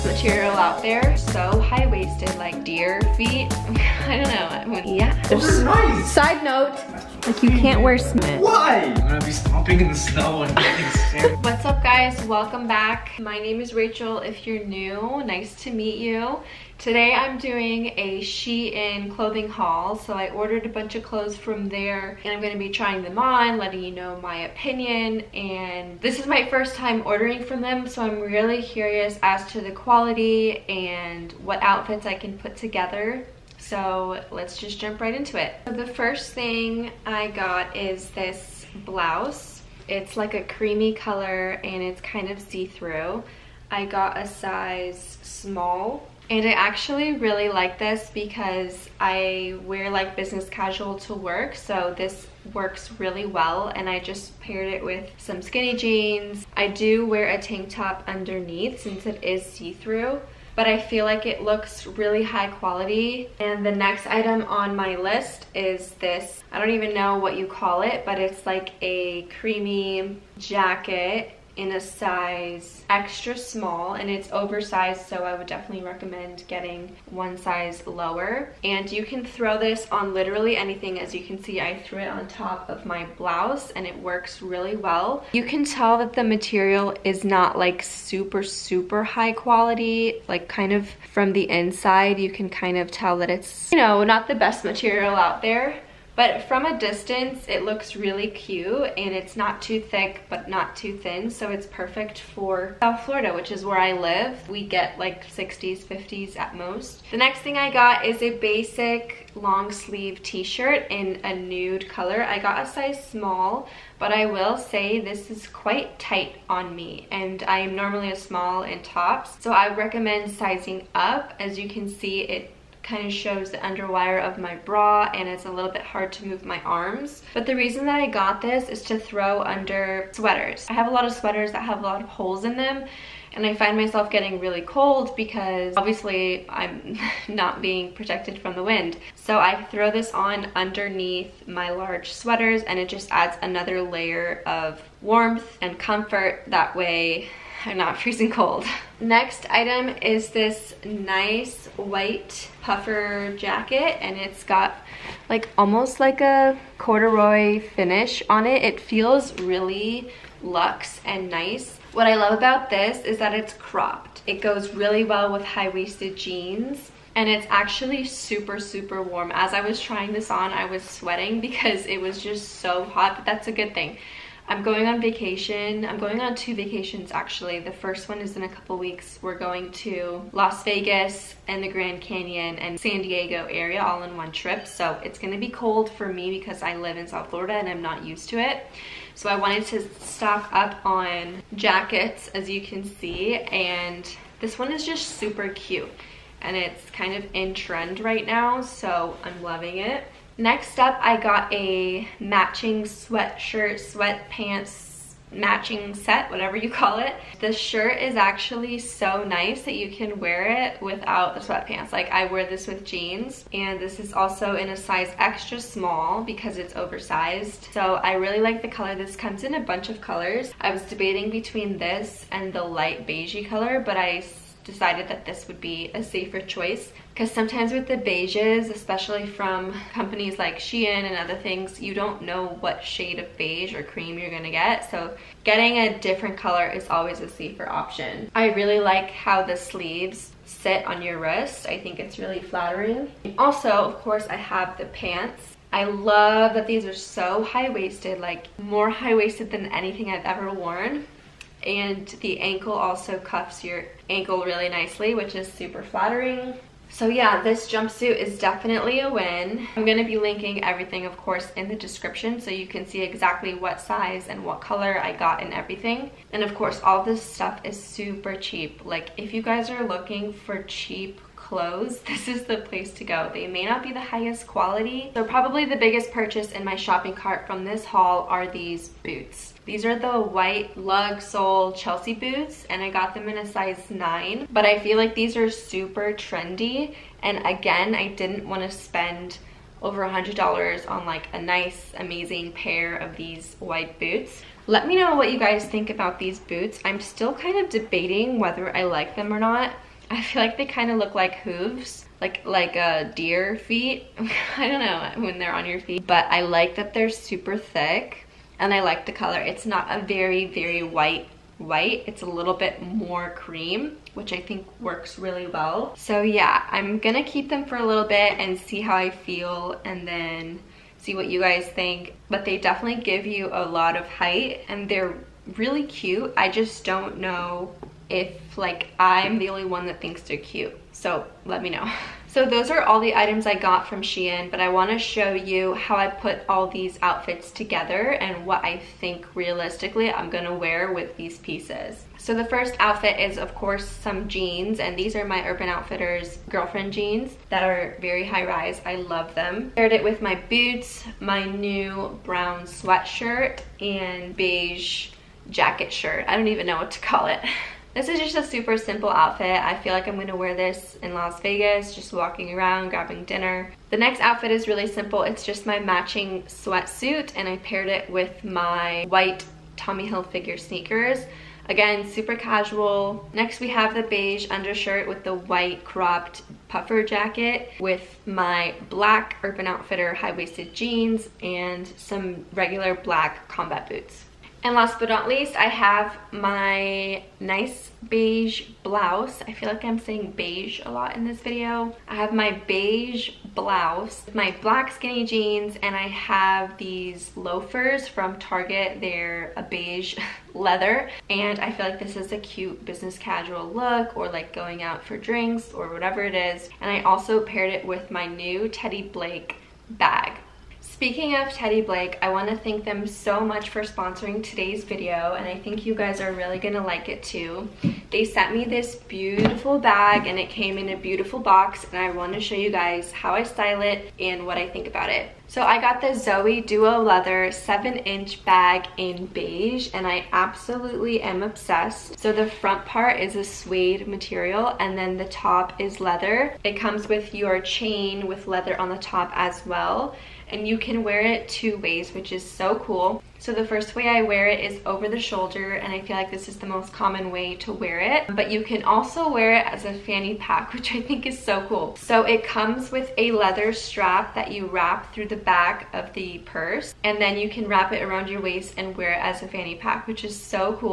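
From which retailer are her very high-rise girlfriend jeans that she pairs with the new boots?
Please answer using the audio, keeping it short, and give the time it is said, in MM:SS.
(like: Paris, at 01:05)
Urban Outfitters, at 05:45.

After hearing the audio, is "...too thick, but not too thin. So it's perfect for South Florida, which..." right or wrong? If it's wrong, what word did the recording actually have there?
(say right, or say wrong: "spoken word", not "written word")
right.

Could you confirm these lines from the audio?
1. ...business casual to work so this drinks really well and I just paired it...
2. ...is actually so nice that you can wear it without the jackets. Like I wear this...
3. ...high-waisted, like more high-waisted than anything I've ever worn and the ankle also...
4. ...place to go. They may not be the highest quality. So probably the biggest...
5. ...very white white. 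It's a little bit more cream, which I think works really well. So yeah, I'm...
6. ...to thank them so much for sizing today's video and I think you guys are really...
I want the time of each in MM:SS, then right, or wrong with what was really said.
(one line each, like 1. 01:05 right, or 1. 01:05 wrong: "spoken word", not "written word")
1. 00:50 wrong: "works", not "drinks"
2. 03:27 wrong: "sweatpants", not "jackets"
3. 04:07 right
4. 04:32 right
5. 05:10 right
6. 06:52 wrong: "sponsoring", not "sizing".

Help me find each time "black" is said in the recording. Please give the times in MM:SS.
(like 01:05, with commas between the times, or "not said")
06:18, 06:22, 06:34.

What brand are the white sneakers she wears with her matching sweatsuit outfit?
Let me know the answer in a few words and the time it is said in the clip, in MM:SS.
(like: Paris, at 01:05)
Tommy Hilfiger, at 06:09.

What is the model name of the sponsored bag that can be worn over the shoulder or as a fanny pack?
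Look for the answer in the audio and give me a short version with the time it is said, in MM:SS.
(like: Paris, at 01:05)
Zoe Duo, at 07:06.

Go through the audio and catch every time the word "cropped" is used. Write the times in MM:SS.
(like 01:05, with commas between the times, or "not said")
02:43, 06:15.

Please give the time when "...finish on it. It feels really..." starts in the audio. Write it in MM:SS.
02:37.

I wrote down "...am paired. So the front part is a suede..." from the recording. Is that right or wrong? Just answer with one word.
wrong.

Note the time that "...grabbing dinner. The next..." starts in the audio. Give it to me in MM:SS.
06:02.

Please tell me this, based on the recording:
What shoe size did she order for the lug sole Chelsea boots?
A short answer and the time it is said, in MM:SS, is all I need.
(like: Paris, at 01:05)
9, at 04:43.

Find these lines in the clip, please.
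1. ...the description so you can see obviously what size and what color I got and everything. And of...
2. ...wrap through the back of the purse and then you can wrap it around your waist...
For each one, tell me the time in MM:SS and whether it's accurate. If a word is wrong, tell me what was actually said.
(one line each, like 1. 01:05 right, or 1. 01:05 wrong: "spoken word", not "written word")
1. 04:21 wrong: "exactly", not "obviously"
2. 07:34 right.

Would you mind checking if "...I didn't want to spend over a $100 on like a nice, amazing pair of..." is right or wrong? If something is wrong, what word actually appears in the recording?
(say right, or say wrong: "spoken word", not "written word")
right.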